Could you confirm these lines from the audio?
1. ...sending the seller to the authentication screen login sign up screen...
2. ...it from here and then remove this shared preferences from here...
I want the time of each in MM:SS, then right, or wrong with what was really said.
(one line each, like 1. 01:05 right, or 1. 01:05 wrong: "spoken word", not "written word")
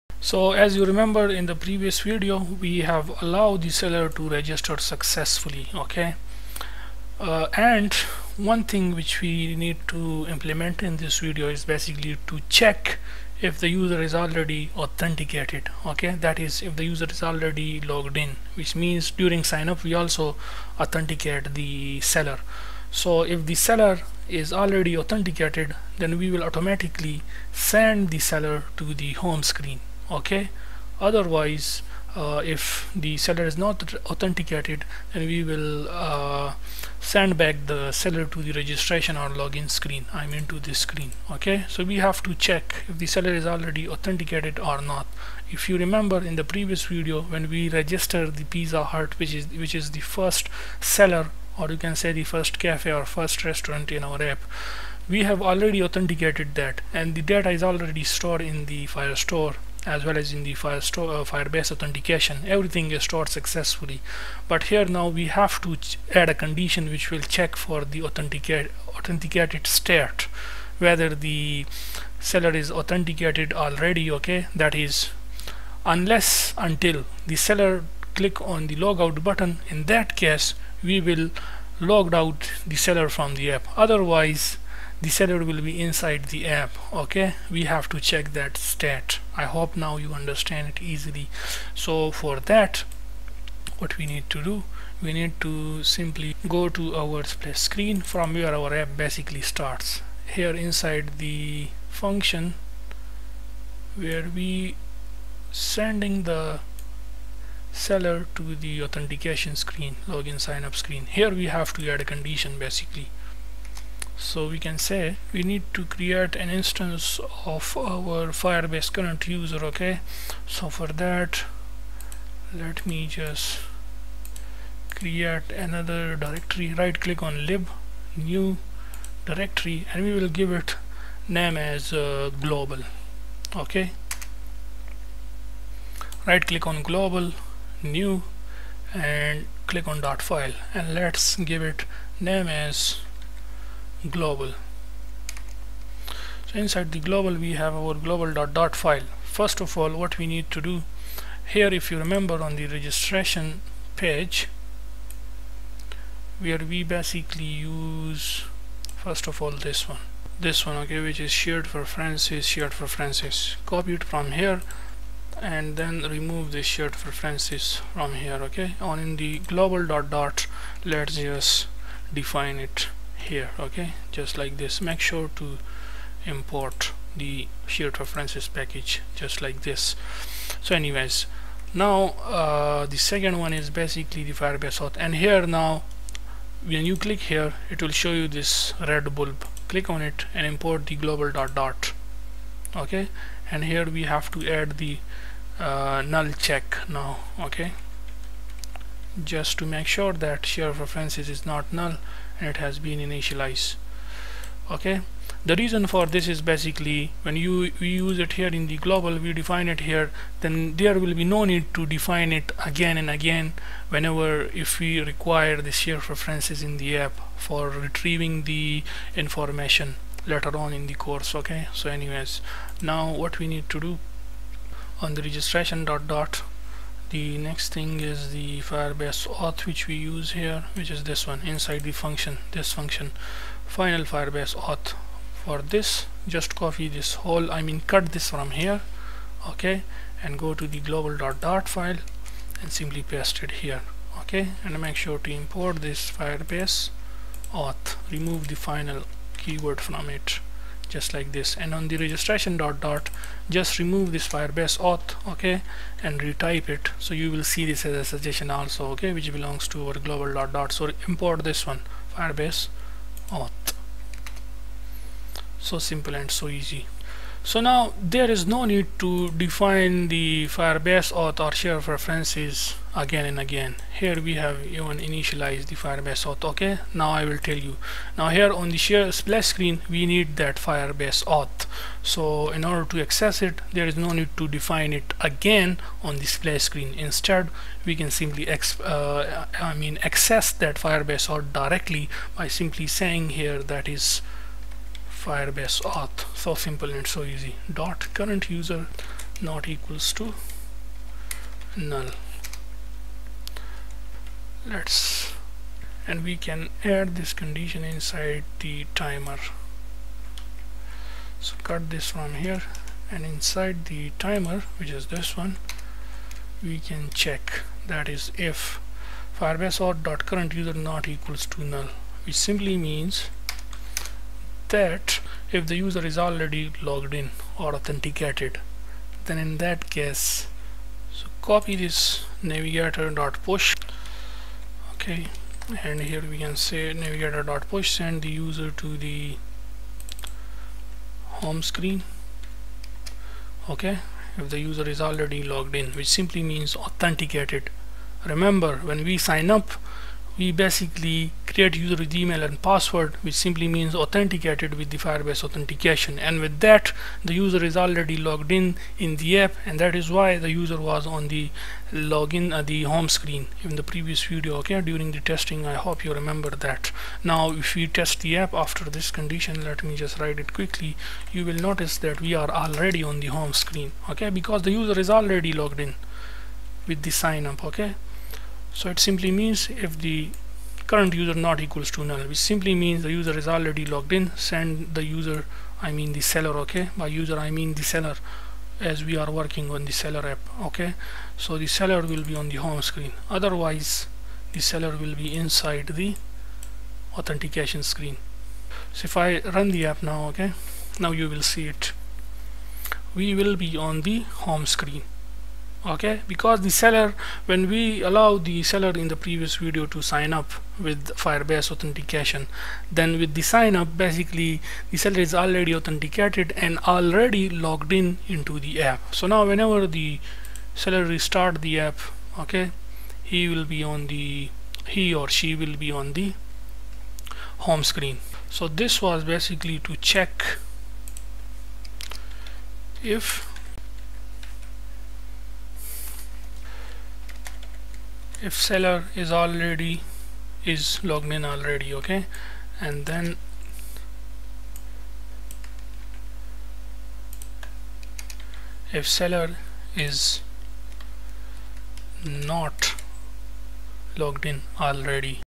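1. 01:45 right
2. 02:43 right.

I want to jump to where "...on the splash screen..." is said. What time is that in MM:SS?
04:46.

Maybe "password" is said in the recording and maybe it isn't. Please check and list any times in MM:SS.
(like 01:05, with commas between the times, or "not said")
05:52.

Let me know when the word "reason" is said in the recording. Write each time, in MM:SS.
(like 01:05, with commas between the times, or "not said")
03:25.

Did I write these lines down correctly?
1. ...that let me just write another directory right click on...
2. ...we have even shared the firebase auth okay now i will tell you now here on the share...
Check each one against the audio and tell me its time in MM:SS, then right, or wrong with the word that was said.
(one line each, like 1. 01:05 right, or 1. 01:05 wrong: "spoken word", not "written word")
1. 02:01 wrong: "create", not "write"
2. 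04:34 wrong: "initialized", not "shared".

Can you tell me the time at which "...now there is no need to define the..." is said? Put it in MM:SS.
04:27.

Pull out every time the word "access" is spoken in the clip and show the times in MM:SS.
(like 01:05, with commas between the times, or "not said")
04:43, 04:50.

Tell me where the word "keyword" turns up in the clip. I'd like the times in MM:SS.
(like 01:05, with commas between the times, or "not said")
04:09.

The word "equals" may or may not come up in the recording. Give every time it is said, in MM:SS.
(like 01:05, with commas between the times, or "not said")
04:59, 05:21, 06:21.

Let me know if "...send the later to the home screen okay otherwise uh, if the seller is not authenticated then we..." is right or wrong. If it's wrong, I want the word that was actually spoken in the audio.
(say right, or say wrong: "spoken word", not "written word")
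wrong: "seller", not "later".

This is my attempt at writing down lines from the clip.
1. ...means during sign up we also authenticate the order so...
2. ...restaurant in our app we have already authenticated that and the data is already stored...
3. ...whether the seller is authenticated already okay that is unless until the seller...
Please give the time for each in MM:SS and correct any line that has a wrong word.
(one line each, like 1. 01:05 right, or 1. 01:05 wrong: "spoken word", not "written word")
1. 00:18 wrong: "seller", not "order"
2. 00:53 right
3. 01:10 right.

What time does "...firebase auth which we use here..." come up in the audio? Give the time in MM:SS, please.
03:48.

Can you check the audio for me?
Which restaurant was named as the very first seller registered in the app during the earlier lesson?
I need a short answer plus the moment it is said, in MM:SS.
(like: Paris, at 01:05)
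Pizza Hut, at 00:48.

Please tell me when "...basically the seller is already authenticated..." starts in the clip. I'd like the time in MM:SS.
06:53.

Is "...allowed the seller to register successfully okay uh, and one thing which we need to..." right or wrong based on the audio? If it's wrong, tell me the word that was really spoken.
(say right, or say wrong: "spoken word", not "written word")
right.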